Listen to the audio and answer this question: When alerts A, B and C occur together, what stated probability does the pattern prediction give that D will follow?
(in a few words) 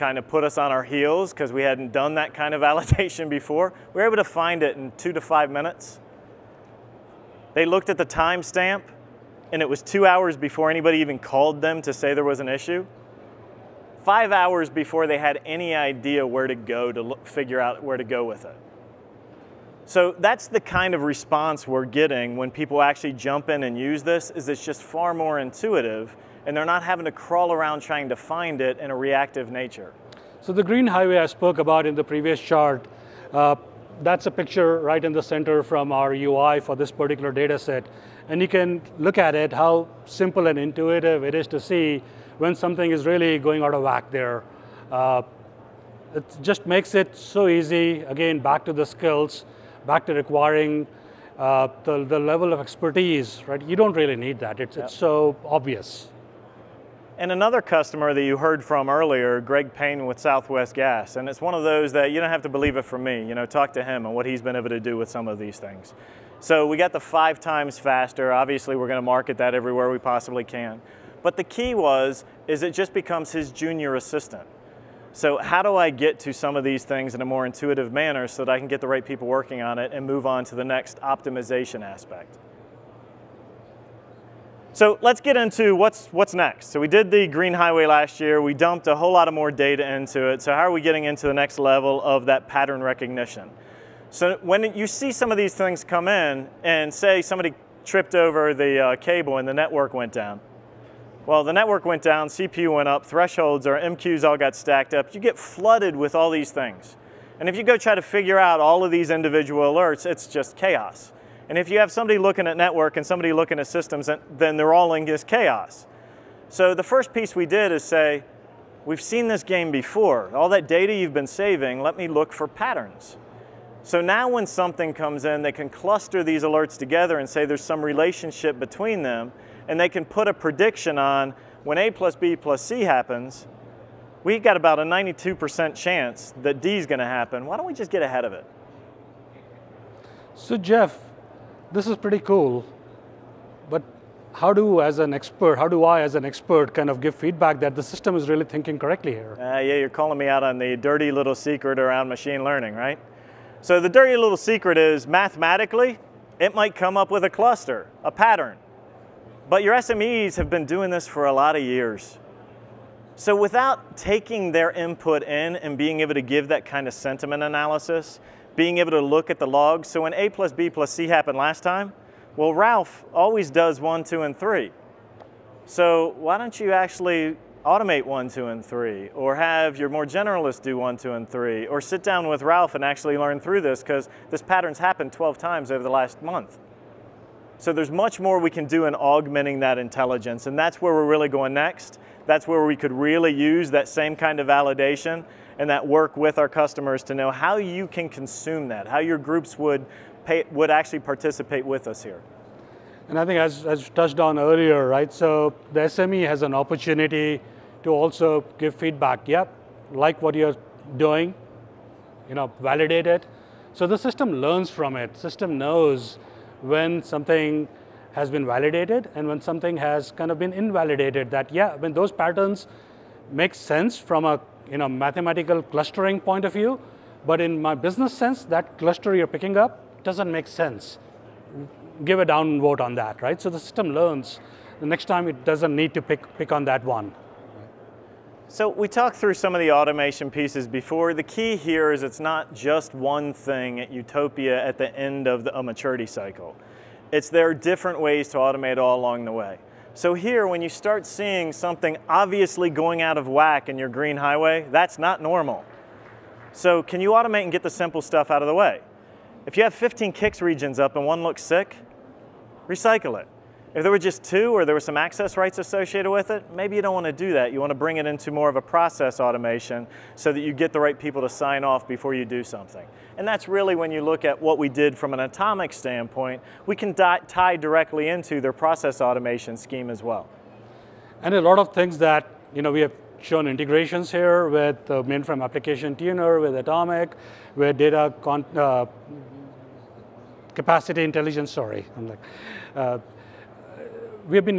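92%.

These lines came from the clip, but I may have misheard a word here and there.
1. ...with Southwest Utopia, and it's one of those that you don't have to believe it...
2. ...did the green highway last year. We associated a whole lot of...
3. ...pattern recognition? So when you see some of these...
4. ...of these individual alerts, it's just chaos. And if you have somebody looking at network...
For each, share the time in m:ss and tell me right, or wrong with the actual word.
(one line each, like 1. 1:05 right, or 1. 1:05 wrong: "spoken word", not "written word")
1. 1:00 wrong: "Gas", not "Utopia"
2. 1:26 wrong: "dumped", not "associated"
3. 1:32 right
4. 1:48 right.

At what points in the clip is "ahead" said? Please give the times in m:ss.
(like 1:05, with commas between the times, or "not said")
2:18.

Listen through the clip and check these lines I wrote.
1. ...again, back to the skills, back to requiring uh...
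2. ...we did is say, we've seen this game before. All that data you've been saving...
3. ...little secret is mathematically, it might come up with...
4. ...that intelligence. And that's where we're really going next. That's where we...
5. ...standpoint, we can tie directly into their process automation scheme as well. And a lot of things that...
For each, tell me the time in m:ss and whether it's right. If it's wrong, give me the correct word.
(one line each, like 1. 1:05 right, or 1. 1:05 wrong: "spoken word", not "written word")
1. 0:48 right
2. 1:57 right
3. 2:34 right
4. 3:09 right
5. 4:35 right.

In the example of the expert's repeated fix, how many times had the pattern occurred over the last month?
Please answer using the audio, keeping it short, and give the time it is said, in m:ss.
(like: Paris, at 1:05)
12, at 3:05.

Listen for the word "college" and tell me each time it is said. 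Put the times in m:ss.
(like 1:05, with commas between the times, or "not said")
not said.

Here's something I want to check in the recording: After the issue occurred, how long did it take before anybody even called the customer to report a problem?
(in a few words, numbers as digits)
2 hours.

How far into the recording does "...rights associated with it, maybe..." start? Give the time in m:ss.
4:25.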